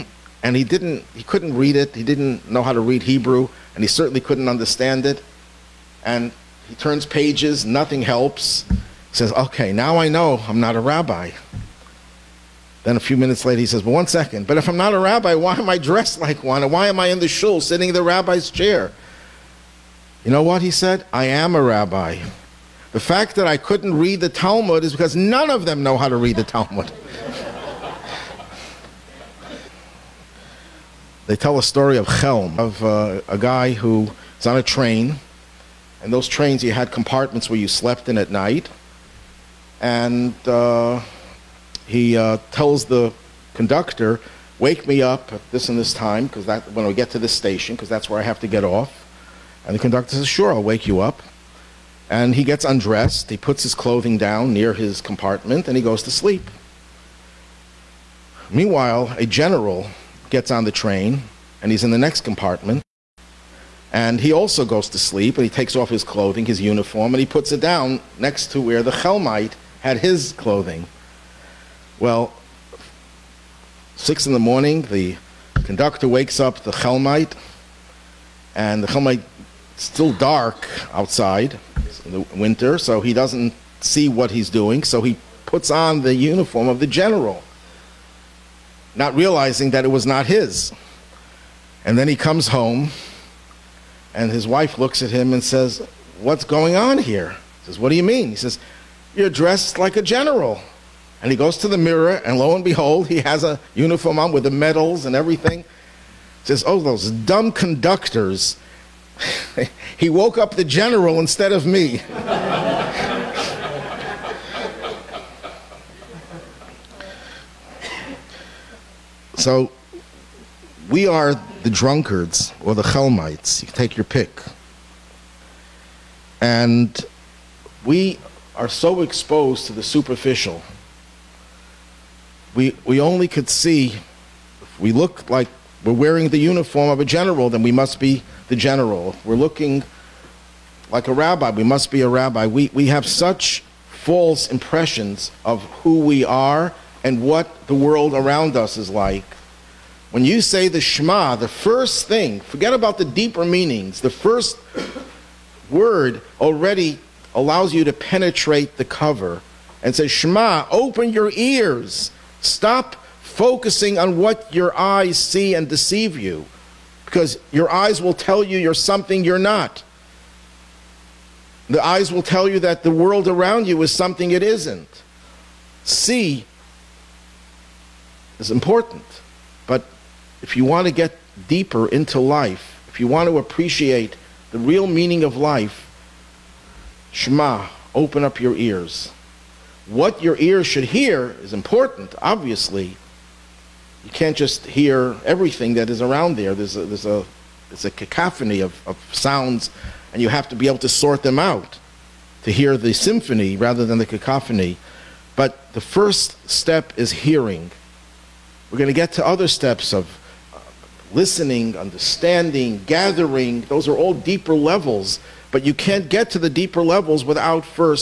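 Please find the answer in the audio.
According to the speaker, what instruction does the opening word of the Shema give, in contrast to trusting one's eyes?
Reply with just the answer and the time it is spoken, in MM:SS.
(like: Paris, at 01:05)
Open your ears, at 02:40.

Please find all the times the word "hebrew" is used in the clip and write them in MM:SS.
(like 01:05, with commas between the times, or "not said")
00:03.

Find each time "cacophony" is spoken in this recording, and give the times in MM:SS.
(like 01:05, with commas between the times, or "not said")
03:17, 03:24.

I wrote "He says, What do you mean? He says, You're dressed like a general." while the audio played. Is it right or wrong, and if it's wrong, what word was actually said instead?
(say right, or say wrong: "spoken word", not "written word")
right.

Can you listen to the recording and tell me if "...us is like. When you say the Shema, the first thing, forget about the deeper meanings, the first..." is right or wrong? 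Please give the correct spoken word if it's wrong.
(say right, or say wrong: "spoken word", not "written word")
right.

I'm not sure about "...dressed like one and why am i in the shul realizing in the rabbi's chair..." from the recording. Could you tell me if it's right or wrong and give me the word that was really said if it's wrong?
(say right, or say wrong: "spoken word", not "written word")
wrong: "sitting", not "realizing".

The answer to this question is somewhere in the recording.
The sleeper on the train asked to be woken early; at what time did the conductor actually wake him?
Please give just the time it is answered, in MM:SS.
01:13.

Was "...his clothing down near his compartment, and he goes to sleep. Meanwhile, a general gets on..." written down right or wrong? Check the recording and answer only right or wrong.
right.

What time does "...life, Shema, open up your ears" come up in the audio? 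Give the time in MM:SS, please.
03:05.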